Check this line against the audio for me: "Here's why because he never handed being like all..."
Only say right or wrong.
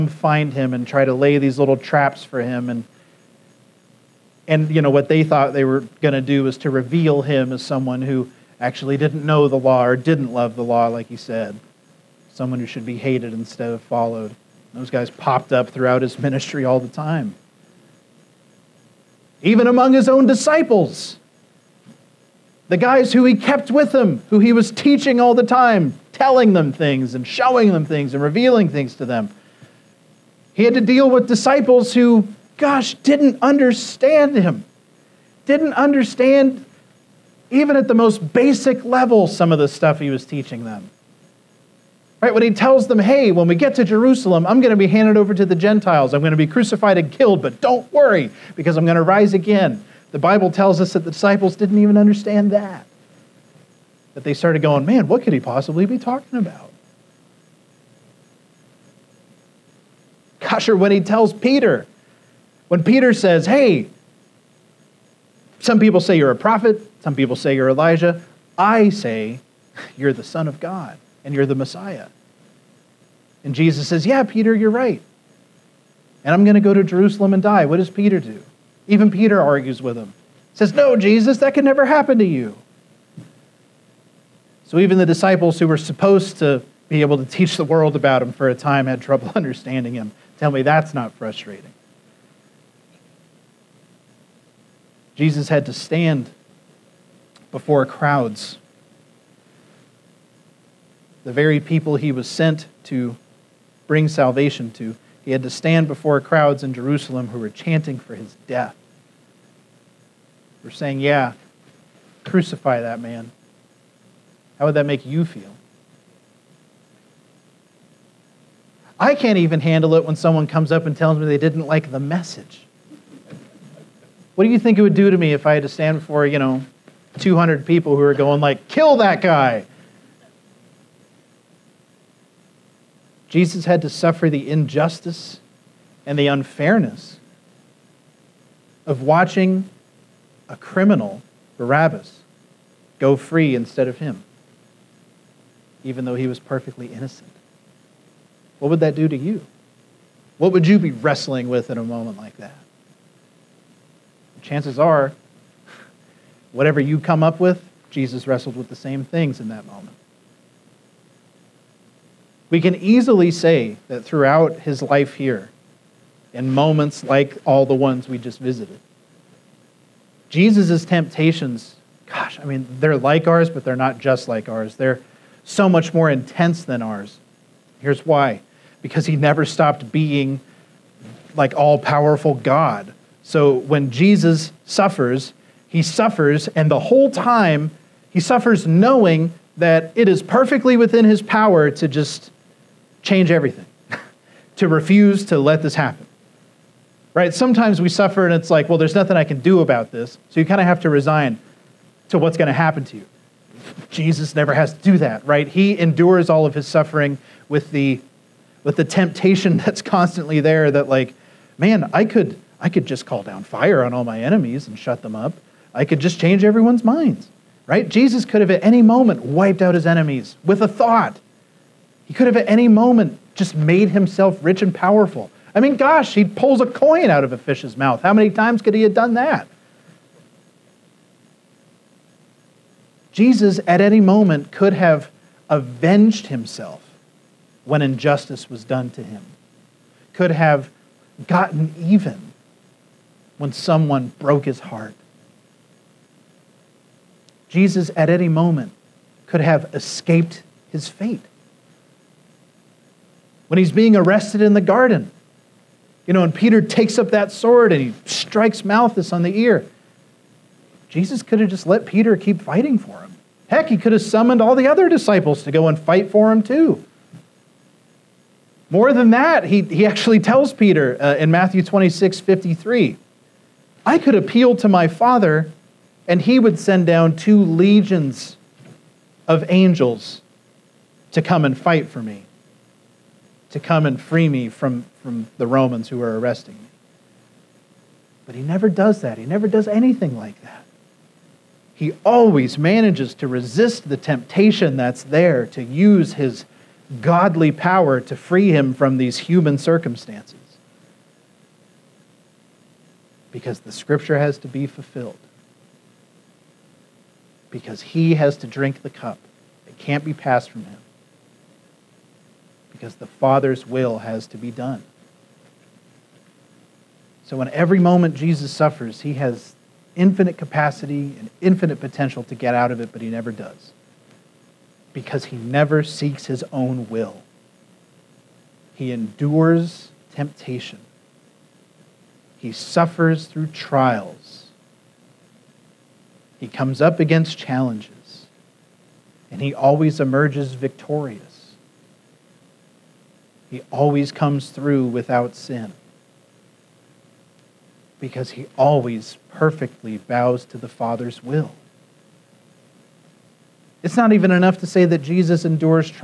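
wrong.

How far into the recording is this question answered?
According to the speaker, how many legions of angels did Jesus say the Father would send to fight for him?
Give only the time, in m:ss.
4:37.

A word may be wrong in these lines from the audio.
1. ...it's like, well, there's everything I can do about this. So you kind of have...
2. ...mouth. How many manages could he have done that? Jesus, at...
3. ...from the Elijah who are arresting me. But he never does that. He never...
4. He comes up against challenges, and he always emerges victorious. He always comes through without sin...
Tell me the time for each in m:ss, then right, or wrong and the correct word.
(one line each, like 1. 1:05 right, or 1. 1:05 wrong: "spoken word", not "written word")
1. 3:18 wrong: "nothing", not "everything"
2. 3:47 wrong: "times", not "manages"
3. 4:45 wrong: "Romans", not "Elijah"
4. 5:36 right.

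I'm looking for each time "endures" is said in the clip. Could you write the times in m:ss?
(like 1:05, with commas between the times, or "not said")
3:25, 5:28, 5:55.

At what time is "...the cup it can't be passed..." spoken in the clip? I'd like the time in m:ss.
5:08.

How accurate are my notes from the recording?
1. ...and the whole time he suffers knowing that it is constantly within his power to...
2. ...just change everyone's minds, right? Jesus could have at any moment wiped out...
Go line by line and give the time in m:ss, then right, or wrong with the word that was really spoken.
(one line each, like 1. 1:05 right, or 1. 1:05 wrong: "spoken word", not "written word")
1. 3:06 wrong: "perfectly", not "constantly"
2. 3:35 right.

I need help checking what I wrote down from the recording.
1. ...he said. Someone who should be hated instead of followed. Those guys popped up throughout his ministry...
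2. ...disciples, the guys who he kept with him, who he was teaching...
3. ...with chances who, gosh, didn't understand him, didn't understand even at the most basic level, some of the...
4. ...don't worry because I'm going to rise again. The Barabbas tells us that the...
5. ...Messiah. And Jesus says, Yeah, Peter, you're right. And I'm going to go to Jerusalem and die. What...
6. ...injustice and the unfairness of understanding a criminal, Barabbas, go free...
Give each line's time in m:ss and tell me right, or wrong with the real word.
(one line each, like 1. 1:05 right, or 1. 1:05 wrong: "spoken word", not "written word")
1. 0:11 right
2. 0:20 right
3. 0:31 wrong: "disciples", not "chances"
4. 0:47 wrong: "Bible", not "Barabbas"
5. 1:11 right
6. 2:14 wrong: "watching", not "understanding".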